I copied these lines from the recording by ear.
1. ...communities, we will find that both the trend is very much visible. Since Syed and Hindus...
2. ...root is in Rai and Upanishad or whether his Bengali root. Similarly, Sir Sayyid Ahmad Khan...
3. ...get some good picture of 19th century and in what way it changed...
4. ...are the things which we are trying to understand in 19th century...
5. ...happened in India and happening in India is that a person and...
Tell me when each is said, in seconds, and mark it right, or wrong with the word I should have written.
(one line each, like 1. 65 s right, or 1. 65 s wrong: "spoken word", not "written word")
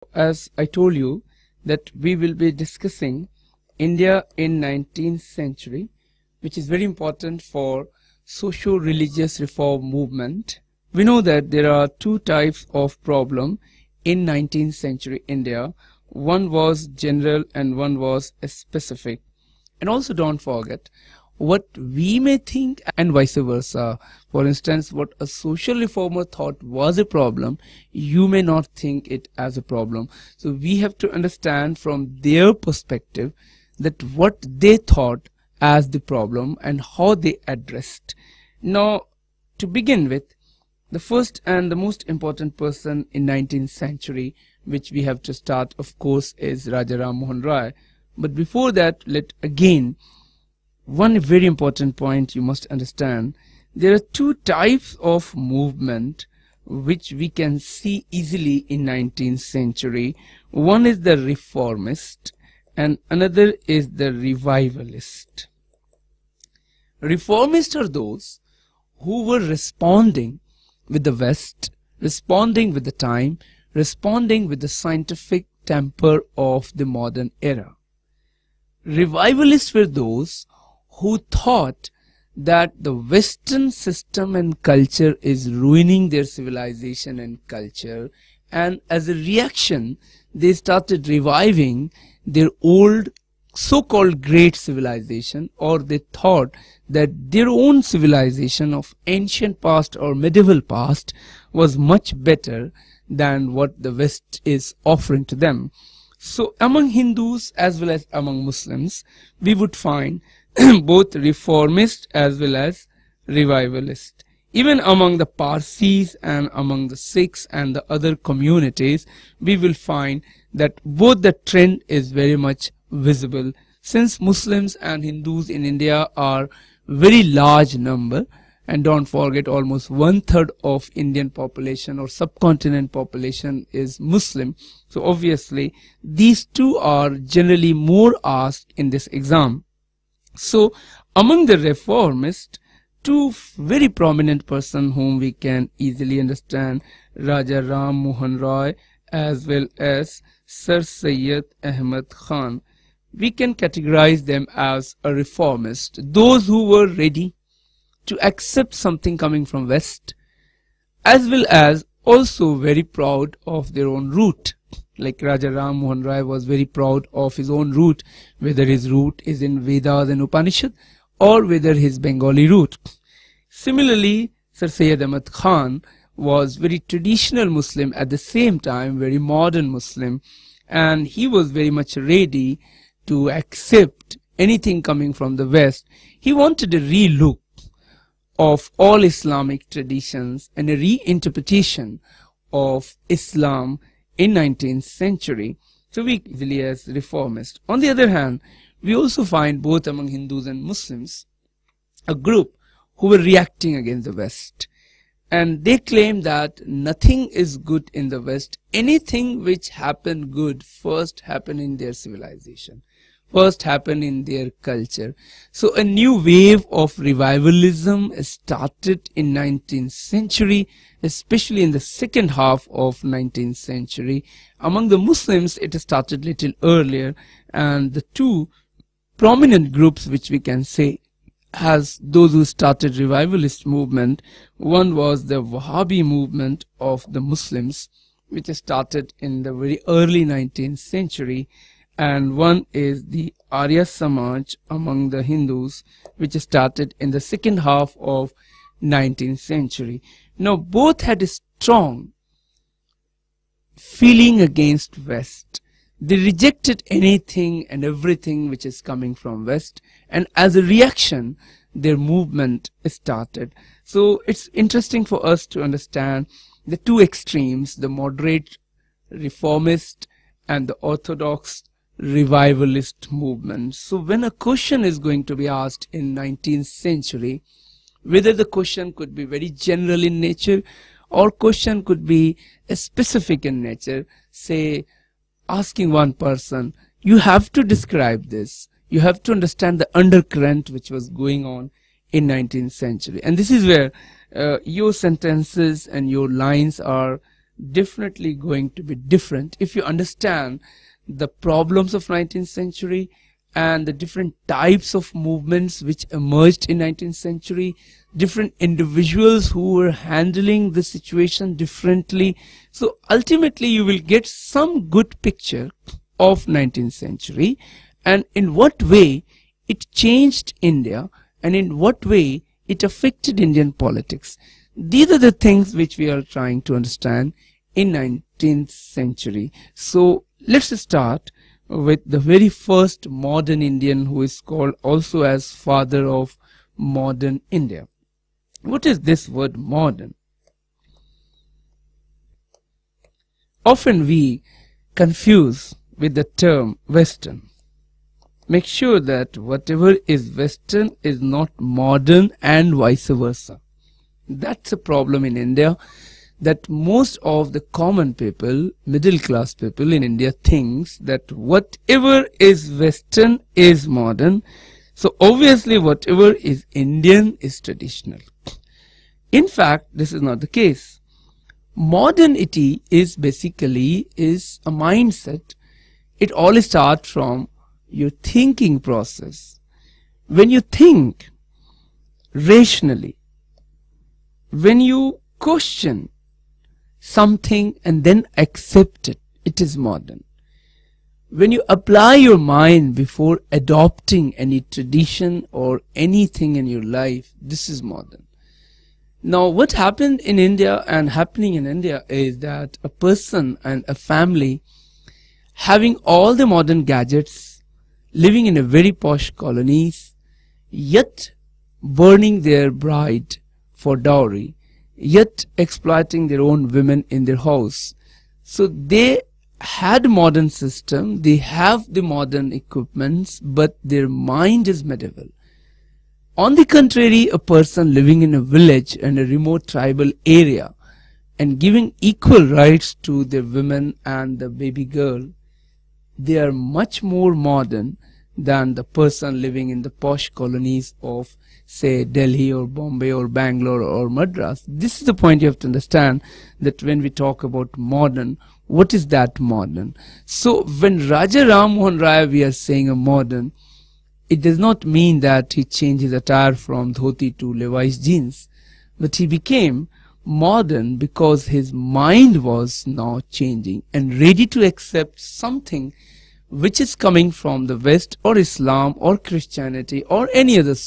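1. 118 s wrong: "Muslims", not "Syed"
2. 168 s wrong: "Vedas", not "Rai"
3. 313 s right
4. 325 s right
5. 399 s right.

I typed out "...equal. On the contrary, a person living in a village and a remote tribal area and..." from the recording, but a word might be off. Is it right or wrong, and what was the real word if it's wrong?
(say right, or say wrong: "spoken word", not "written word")
wrong: "medieval", not "equal".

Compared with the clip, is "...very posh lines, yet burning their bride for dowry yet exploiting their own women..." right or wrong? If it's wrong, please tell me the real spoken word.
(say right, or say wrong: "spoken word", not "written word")
wrong: "colonies", not "lines".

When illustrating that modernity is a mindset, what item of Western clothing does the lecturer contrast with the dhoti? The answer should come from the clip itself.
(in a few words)
Levi's jeans.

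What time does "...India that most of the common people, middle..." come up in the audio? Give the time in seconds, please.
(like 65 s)
355 s.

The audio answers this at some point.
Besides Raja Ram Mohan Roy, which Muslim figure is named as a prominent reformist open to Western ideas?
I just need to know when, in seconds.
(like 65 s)
150 s.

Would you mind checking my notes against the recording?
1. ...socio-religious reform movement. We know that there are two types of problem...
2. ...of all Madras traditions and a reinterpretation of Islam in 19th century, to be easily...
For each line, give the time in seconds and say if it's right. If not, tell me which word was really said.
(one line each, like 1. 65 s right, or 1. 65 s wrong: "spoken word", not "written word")
1. 8 s right
2. 188 s wrong: "Islamic", not "Madras".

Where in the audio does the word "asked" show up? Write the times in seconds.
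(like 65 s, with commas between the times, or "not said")
138 s, 275 s.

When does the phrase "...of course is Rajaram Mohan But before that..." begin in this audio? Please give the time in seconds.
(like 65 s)
45 s.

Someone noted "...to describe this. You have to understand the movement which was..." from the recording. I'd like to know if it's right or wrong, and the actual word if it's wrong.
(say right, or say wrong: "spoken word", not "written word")
wrong: "undercurrent", not "movement".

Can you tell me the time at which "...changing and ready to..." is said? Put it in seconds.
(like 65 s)
463 s.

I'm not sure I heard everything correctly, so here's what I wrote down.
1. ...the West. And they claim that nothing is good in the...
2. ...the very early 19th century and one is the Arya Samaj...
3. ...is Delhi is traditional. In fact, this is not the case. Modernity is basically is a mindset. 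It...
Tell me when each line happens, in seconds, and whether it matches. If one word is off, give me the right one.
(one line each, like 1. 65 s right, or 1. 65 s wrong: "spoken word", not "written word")
1. 204 s right
2. 239 s right
3. 366 s wrong: "Indian", not "Delhi".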